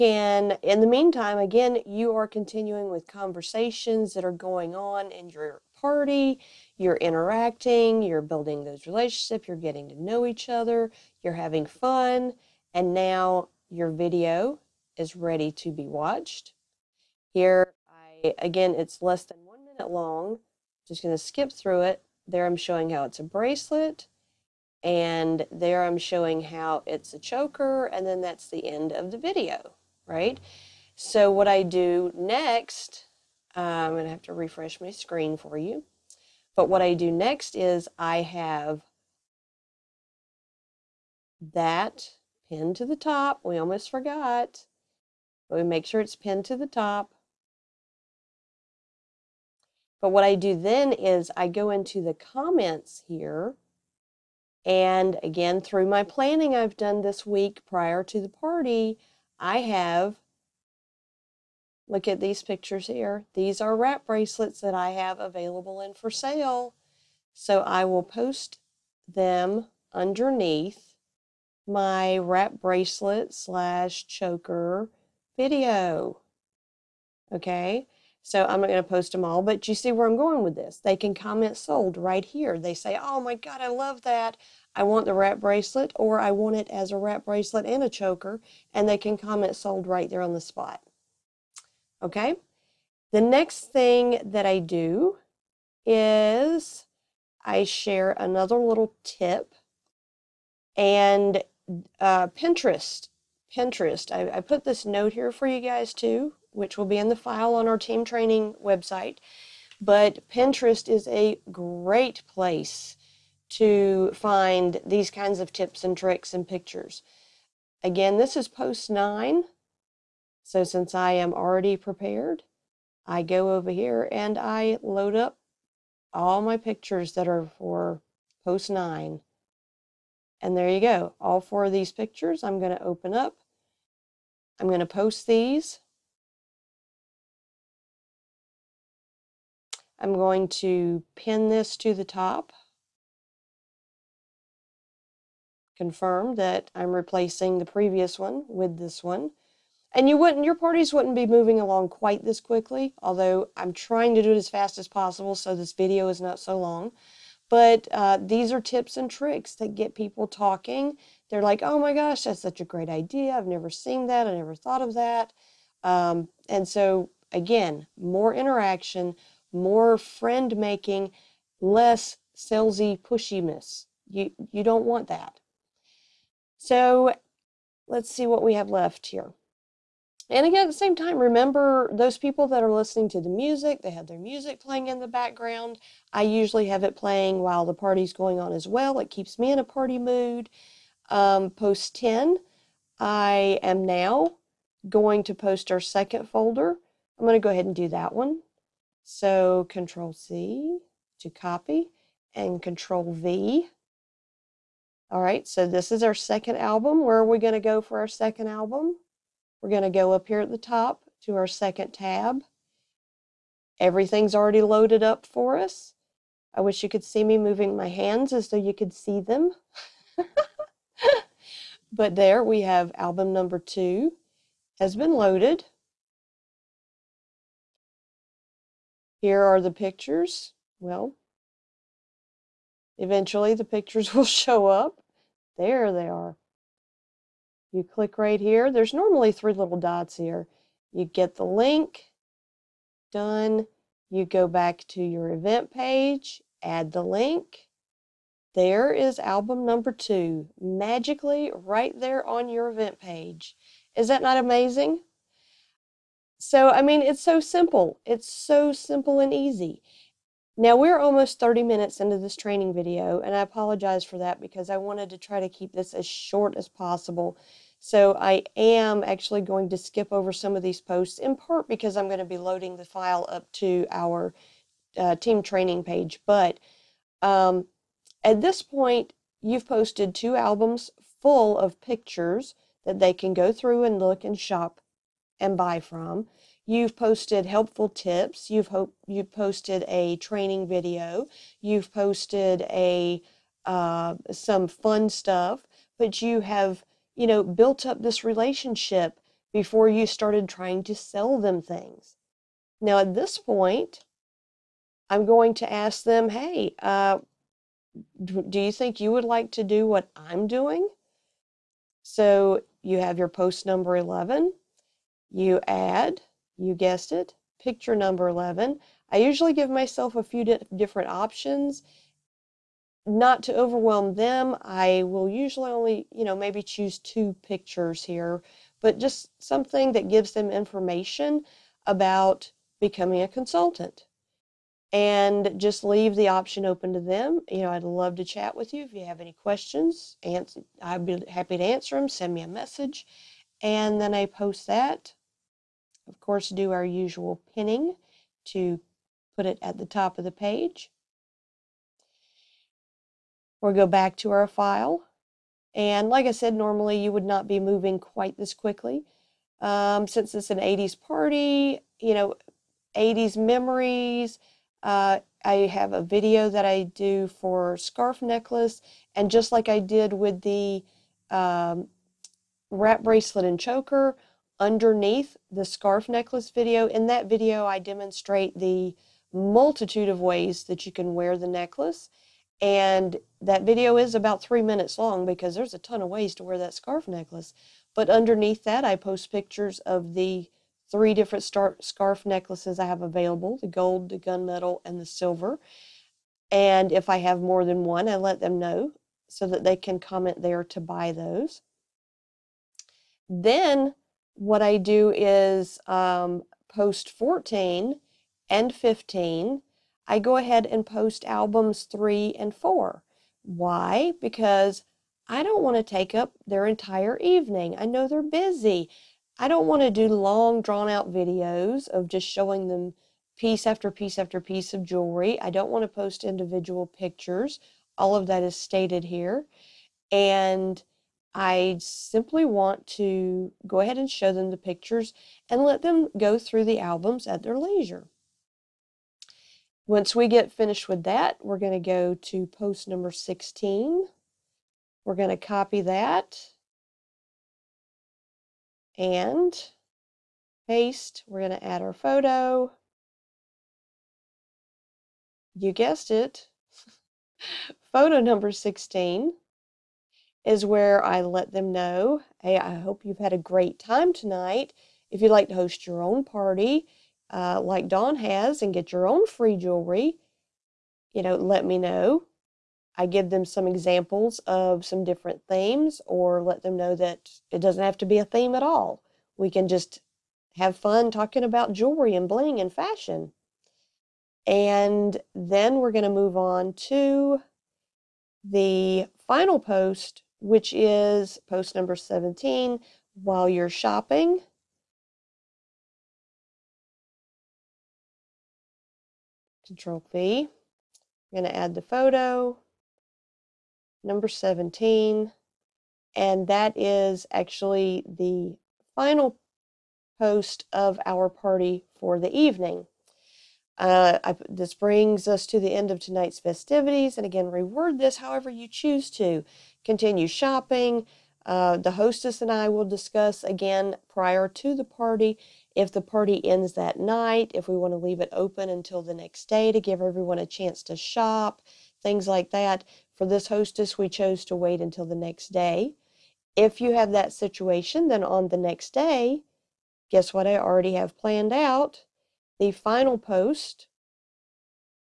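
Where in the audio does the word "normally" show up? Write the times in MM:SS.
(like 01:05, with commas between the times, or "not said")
03:58, 05:56.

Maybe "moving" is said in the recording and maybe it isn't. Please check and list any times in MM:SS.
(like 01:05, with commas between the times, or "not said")
02:31, 03:37, 05:57.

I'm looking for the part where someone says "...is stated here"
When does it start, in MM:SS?
07:08.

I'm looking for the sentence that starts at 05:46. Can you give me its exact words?
Of course, do our usual pinning to put it at the top of the page.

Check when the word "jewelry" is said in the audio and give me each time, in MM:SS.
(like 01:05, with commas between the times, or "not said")
07:04, 07:49, 08:01.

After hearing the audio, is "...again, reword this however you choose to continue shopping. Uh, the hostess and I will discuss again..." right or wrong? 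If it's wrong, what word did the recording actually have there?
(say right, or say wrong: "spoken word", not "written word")
right.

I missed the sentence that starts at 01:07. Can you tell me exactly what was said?
So I will post them underneath my wrap bracelet slash choker video.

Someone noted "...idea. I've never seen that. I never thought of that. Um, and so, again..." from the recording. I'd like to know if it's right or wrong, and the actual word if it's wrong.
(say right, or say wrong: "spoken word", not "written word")
right.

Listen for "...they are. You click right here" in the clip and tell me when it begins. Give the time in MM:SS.
03:55.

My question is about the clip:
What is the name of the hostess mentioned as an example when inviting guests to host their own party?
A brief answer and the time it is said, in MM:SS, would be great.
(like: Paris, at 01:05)
Dawn, at 07:47.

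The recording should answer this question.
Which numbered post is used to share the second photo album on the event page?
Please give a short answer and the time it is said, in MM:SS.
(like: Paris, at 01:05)
10, at 03:11.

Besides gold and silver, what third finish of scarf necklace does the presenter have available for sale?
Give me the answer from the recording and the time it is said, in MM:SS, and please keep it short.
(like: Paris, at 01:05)
Gunmetal, at 06:34.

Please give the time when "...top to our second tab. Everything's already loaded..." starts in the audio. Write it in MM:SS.
03:30.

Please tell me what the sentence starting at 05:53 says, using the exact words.
Or we'll go back to our file.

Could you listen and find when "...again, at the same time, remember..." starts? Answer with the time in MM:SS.
03:00.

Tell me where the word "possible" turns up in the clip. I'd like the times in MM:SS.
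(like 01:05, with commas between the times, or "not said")
02:34, 04:26.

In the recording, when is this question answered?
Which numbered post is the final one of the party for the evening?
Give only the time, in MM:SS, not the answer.
08:11.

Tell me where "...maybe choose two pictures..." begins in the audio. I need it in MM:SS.
05:26.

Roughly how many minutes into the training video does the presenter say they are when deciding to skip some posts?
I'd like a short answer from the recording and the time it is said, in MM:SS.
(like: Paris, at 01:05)
30, at 04:21.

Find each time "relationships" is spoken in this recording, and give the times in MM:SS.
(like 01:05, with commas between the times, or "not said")
00:08, 04:58.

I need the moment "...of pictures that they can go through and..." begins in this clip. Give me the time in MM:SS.
04:41.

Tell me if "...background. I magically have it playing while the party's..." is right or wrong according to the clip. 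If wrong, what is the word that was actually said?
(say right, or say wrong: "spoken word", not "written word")
wrong: "usually", not "magically".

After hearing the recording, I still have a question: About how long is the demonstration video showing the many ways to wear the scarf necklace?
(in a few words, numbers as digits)
About three minutes.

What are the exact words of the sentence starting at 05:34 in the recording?
And just leave the option open to them.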